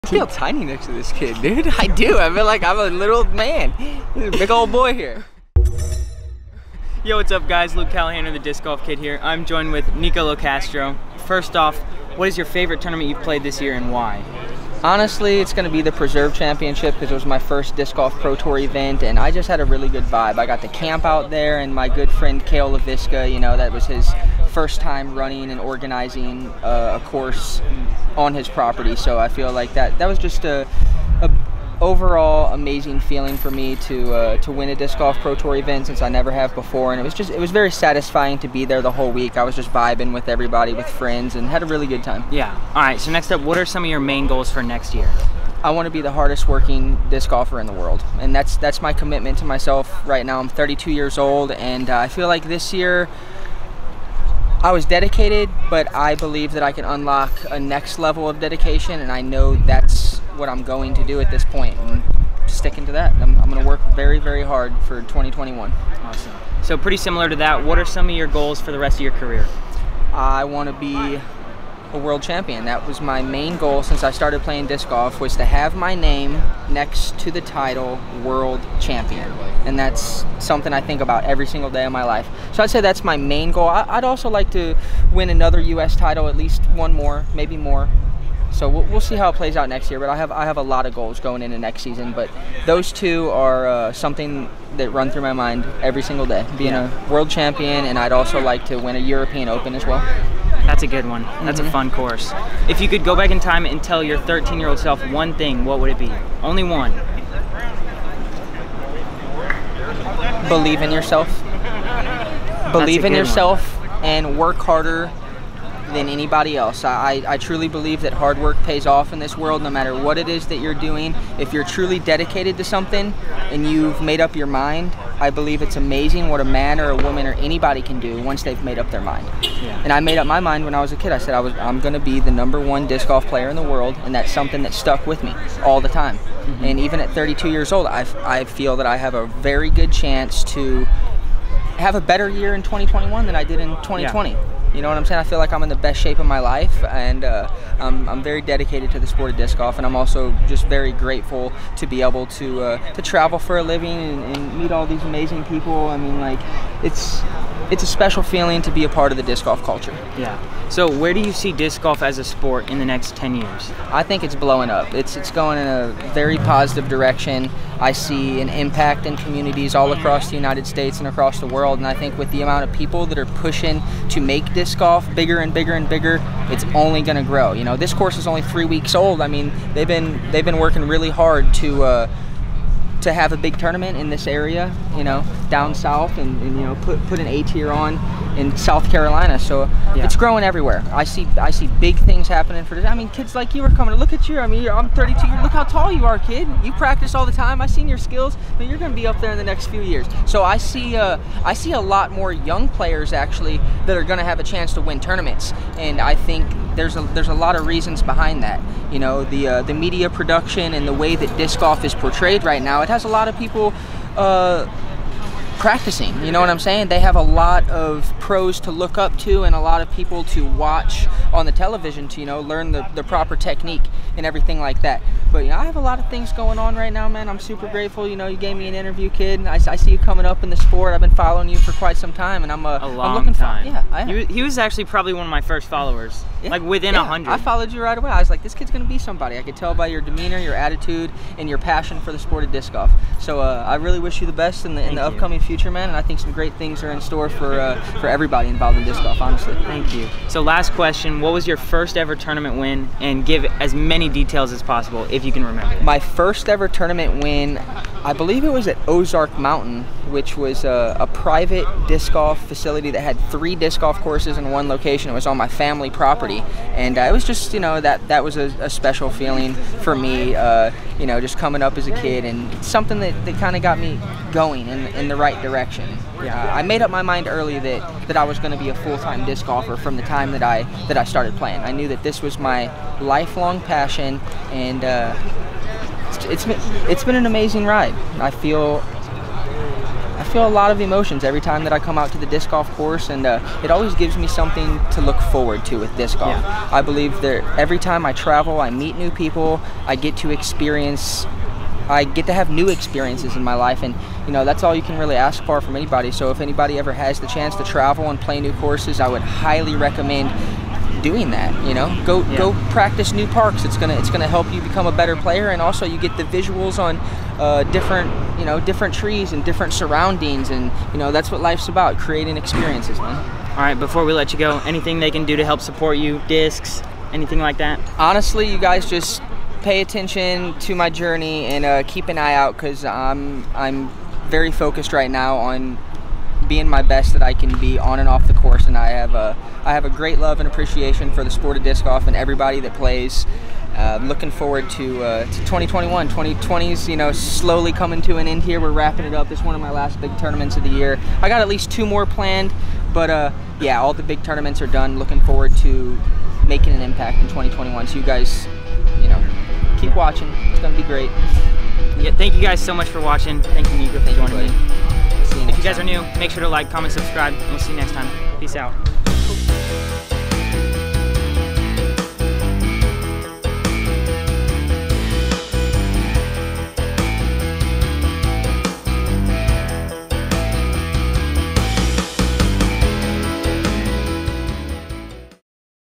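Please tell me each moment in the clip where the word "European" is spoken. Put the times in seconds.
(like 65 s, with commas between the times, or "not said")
98 s.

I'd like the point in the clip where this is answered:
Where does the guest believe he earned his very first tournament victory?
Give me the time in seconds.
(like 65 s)
258 s.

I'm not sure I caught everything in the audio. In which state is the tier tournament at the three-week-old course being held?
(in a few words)
South Carolina.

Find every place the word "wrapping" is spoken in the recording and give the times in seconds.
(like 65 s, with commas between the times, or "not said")
348 s.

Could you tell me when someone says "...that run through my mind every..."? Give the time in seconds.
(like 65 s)
94 s.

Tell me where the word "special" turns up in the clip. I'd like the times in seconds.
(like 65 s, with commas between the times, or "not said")
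157 s, 268 s.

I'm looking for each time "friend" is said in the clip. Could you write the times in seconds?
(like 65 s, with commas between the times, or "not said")
22 s, 40 s.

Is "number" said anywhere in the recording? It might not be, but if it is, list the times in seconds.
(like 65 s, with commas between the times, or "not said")
132 s.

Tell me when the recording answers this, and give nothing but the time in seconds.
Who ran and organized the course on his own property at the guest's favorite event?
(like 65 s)
22 s.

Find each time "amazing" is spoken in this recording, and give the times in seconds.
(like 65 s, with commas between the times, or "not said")
32 s, 125 s, 155 s, 287 s.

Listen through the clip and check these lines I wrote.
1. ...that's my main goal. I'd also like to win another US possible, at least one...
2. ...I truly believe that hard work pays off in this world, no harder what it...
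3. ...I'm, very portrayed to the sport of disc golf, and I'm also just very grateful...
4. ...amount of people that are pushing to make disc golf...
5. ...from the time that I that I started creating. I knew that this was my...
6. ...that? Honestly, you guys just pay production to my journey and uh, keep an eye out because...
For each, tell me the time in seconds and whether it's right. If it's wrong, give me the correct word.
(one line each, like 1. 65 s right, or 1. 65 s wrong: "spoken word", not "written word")
1. 82 s wrong: "title", not "possible"
2. 117 s wrong: "matter", not "harder"
3. 148 s wrong: "dedicated", not "portrayed"
4. 172 s right
5. 279 s wrong: "playing", not "creating"
6. 327 s wrong: "attention", not "production".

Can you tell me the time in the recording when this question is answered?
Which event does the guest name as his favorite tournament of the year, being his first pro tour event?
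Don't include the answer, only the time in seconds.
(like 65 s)
15 s.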